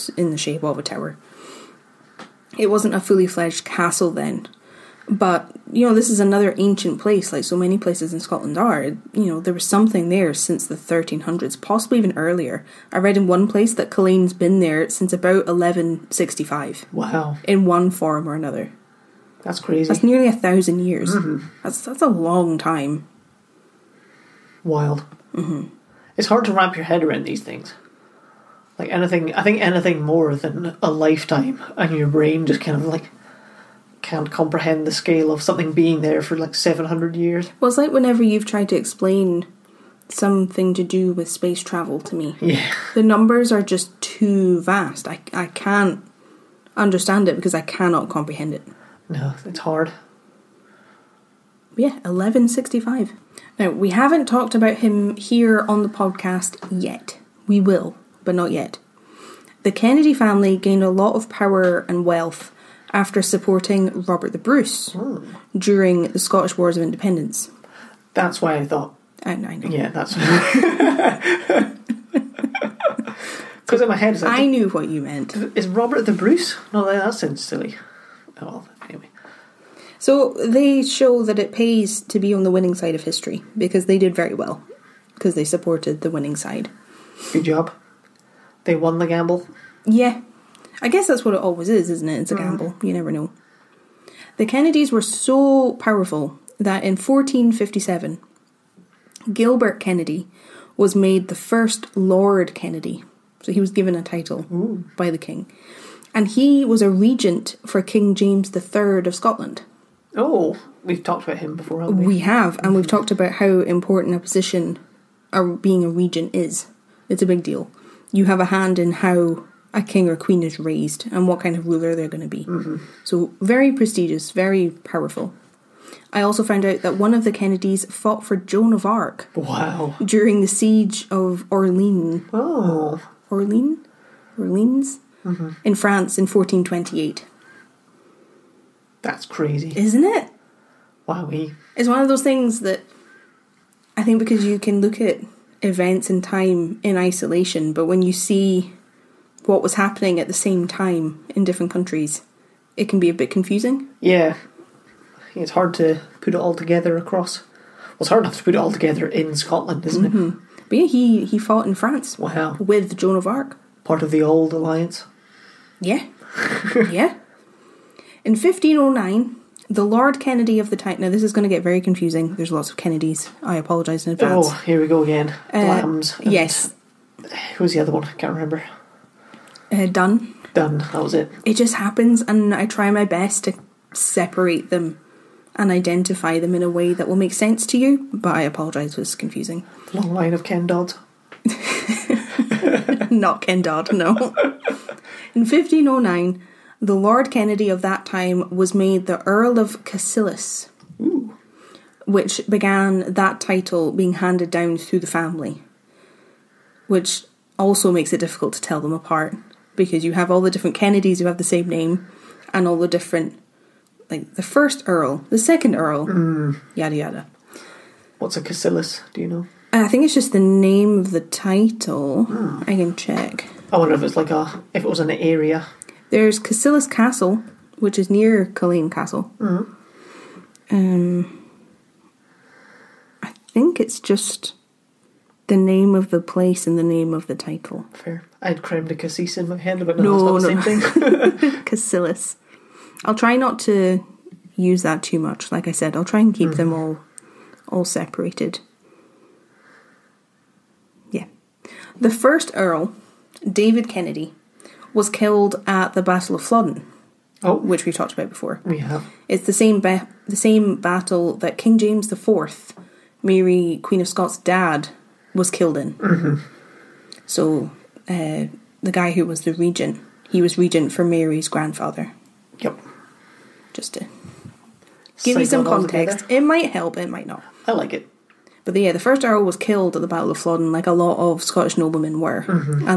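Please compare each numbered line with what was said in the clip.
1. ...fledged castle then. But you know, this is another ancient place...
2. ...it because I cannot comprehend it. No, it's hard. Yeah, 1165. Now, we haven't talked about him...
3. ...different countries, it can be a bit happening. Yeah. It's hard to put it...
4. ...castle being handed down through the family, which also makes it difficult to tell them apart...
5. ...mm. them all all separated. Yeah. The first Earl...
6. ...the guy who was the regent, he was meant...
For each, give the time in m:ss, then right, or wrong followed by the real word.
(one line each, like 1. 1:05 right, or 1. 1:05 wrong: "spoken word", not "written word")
1. 0:03 right
2. 0:47 right
3. 2:31 wrong: "confusing", not "happening"
4. 3:23 wrong: "title", not "castle"
5. 4:06 right
6. 4:28 wrong: "regent", not "meant".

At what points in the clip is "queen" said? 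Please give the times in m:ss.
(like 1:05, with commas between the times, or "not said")
2:00, 4:23.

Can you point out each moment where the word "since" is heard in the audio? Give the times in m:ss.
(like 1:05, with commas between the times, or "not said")
0:10, 0:14.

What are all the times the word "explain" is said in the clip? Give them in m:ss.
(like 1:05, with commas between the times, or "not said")
0:38.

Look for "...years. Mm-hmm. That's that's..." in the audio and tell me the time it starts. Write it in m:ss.
0:20.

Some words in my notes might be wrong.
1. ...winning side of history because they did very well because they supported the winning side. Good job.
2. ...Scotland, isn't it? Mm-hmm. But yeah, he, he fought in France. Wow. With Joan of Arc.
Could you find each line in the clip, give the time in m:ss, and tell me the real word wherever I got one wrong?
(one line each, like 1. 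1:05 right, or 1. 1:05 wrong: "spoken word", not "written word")
1. 1:22 right
2. 2:39 right.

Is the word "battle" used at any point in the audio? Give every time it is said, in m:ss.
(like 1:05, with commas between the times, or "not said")
4:16, 4:20, 4:40.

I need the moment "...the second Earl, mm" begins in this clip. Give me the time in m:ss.
3:35.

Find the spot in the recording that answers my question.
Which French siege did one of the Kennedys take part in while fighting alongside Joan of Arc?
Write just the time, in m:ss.
2:10.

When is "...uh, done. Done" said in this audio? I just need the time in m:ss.
2:59.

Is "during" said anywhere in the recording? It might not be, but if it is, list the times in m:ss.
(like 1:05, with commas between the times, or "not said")
1:05, 2:10.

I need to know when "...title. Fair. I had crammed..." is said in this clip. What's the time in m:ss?
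3:57.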